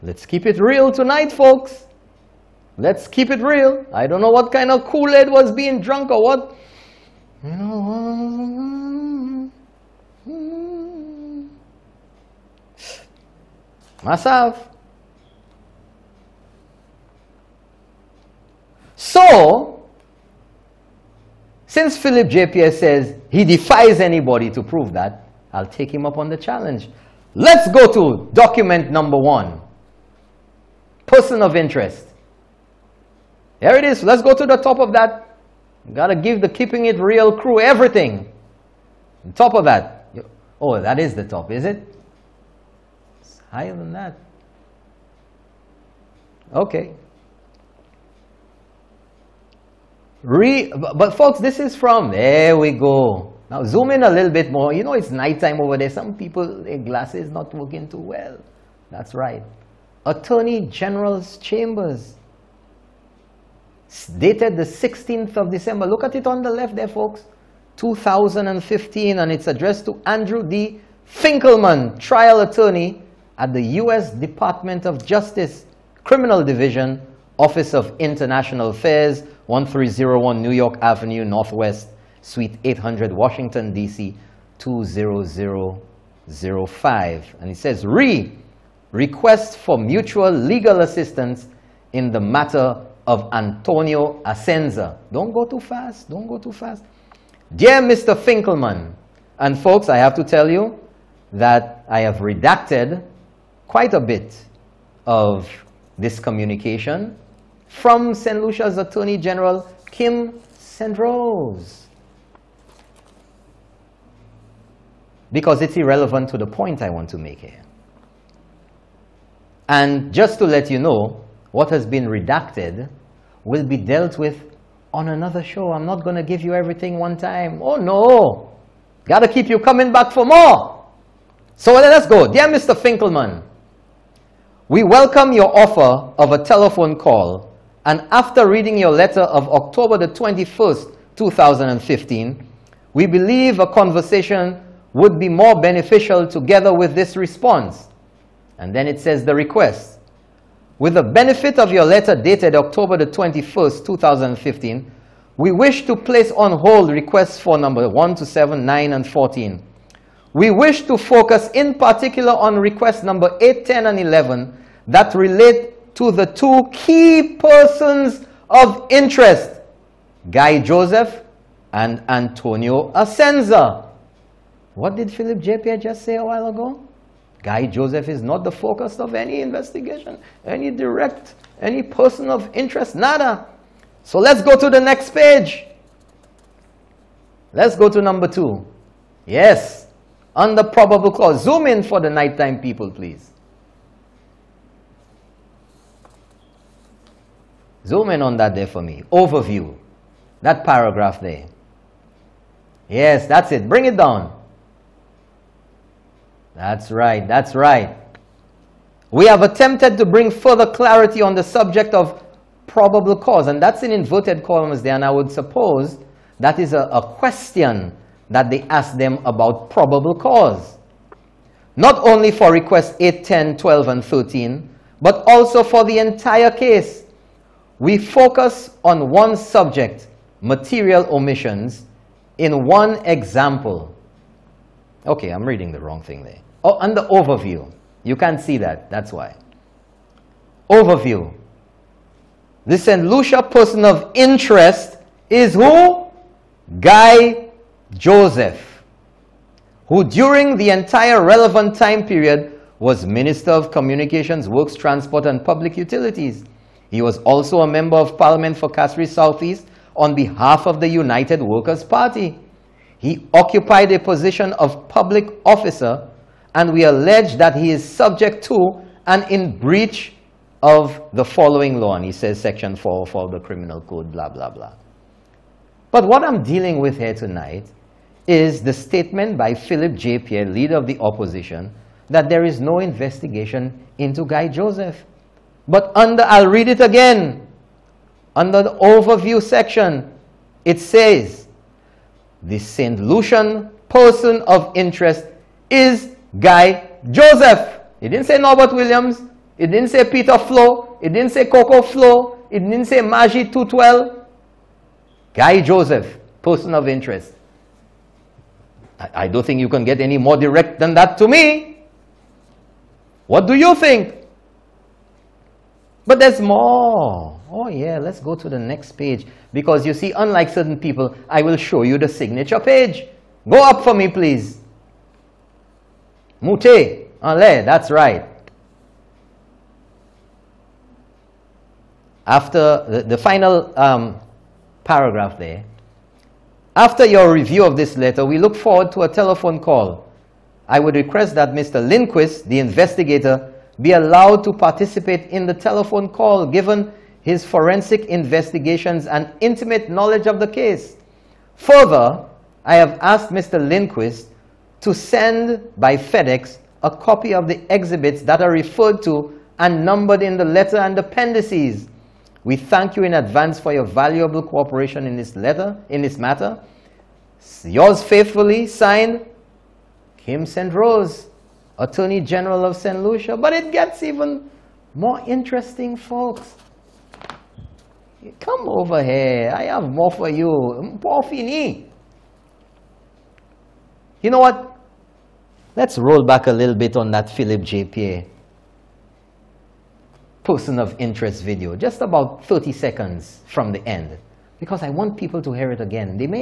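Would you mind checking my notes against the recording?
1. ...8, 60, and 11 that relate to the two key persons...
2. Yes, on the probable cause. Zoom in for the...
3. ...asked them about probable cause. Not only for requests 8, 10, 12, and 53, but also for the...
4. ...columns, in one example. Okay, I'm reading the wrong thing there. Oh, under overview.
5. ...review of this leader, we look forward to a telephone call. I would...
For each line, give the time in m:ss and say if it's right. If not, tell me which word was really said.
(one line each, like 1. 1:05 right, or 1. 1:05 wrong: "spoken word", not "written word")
1. 2:43 wrong: "10", not "60"
2. 3:09 right
3. 3:38 wrong: "13", not "53"
4. 3:51 wrong: "omissions", not "columns"
5. 5:37 wrong: "letter", not "leader".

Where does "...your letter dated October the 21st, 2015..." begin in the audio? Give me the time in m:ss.
2:31.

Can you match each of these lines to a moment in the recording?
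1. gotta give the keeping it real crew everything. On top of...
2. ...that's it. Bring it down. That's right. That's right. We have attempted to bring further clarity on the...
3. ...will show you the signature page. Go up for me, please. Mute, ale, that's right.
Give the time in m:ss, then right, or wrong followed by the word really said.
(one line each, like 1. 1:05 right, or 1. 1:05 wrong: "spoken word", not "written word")
1. 0:35 right
2. 3:23 right
3. 5:21 right.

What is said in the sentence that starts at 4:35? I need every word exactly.
But what I'm dealing with here tonight is the statement by Philip J.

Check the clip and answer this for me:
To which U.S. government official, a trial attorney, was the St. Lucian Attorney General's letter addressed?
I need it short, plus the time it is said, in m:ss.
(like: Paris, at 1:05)
Andrew D. Finkelman, at 1:10.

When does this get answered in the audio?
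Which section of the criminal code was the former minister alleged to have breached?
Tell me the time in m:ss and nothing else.
4:32.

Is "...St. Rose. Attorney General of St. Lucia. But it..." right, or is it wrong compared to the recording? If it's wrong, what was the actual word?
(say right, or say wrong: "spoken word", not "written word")
right.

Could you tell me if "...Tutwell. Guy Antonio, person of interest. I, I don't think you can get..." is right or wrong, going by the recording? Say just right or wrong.
wrong.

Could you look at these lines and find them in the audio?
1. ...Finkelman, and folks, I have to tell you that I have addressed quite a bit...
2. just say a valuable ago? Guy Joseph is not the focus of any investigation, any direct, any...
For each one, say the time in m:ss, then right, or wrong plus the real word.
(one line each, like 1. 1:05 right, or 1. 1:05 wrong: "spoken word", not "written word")
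1. 1:38 wrong: "redacted", not "addressed"
2. 2:55 wrong: "while", not "valuable".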